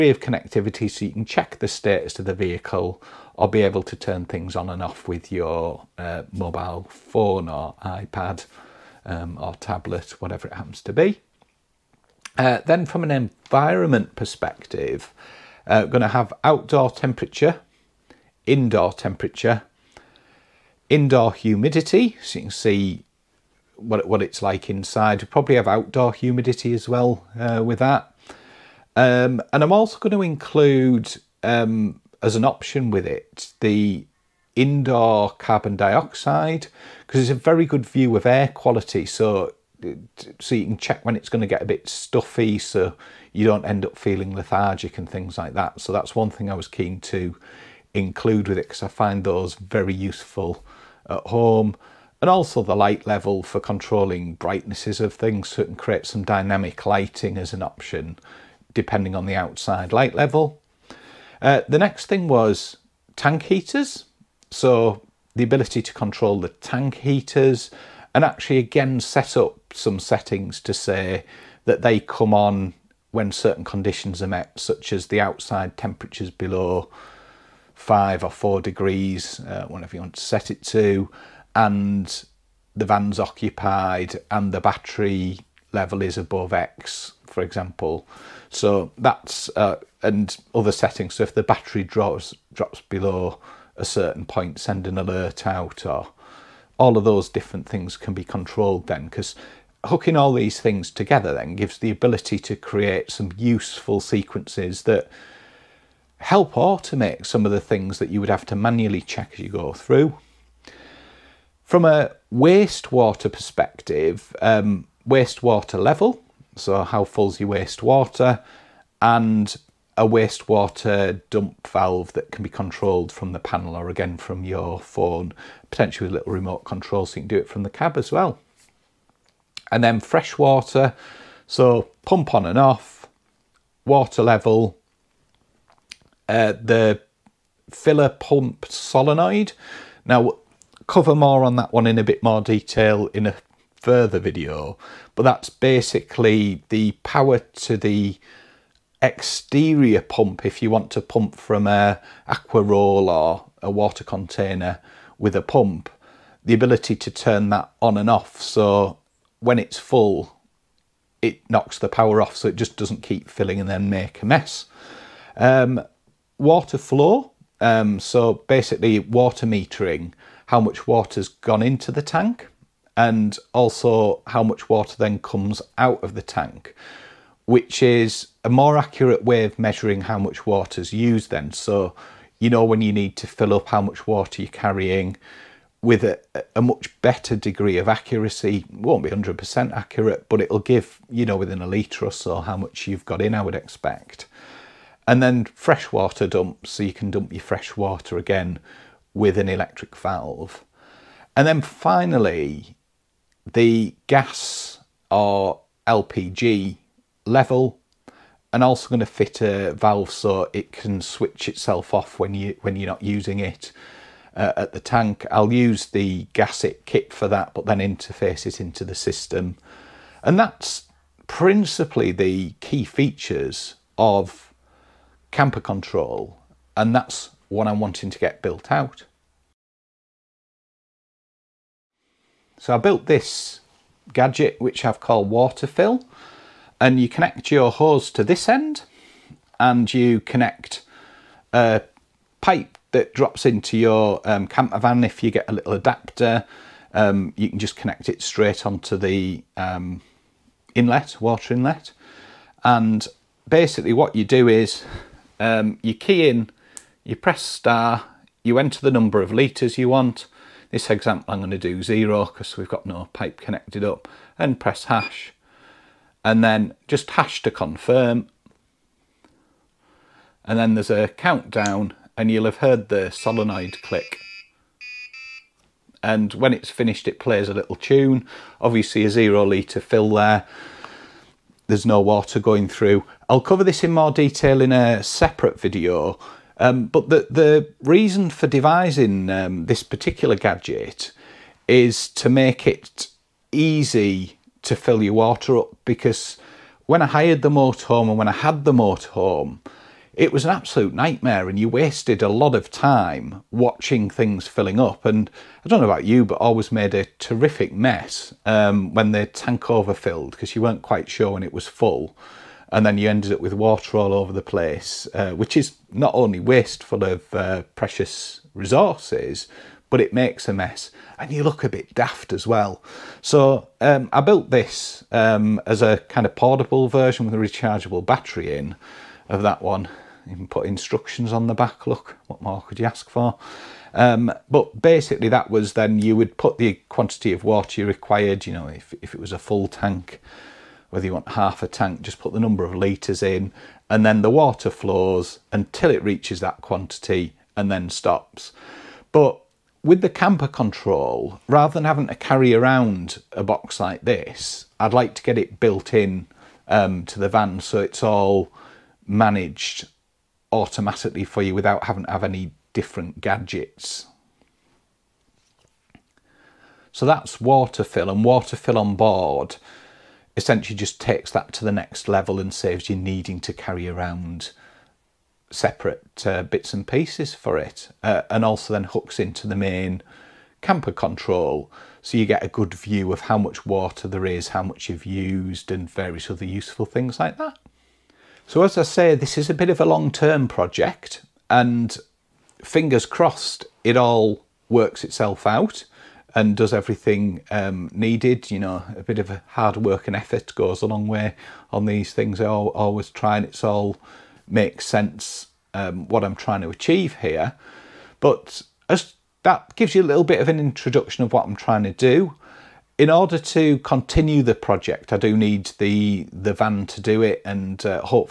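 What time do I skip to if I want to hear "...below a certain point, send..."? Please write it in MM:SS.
01:32.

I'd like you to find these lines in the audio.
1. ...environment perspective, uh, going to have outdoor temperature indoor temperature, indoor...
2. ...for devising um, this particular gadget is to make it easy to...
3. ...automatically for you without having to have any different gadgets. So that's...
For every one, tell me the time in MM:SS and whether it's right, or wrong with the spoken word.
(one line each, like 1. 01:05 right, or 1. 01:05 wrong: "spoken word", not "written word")
1. 00:13 right
2. 04:48 right
3. 06:00 right.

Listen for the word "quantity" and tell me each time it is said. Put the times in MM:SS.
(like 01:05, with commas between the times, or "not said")
05:36, 05:46.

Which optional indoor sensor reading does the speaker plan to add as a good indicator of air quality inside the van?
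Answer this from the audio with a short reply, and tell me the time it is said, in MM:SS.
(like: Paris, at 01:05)
Carbon dioxide, at 00:35.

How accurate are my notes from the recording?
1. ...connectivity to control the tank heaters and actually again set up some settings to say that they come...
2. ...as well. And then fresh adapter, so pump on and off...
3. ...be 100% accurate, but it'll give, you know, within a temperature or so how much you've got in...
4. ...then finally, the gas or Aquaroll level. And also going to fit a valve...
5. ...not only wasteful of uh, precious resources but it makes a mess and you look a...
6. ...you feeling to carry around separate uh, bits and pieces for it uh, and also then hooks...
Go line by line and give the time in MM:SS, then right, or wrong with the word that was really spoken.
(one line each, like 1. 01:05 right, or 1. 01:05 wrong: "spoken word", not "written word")
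1. 01:05 wrong: "ability", not "connectivity"
2. 02:07 wrong: "water", not "adapter"
3. 03:09 wrong: "litre", not "temperature"
4. 03:21 wrong: "LPG", not "Aquaroll"
5. 05:15 right
6. 06:12 wrong: "needing", not "feeling".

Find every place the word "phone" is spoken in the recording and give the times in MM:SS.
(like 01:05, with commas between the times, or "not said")
00:06, 02:04.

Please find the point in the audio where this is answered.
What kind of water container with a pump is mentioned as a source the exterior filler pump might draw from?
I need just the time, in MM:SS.
02:32.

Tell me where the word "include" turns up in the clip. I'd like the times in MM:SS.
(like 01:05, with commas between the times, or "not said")
00:30, 00:47.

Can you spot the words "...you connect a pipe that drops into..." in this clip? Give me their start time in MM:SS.
03:59.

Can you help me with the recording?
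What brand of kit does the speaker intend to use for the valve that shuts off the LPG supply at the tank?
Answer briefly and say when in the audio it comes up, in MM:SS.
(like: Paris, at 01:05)
GasIt, at 03:36.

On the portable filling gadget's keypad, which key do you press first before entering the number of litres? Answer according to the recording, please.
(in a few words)
Star.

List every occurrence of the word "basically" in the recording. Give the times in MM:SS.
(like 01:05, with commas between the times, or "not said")
02:25, 02:48, 04:13, 05:34.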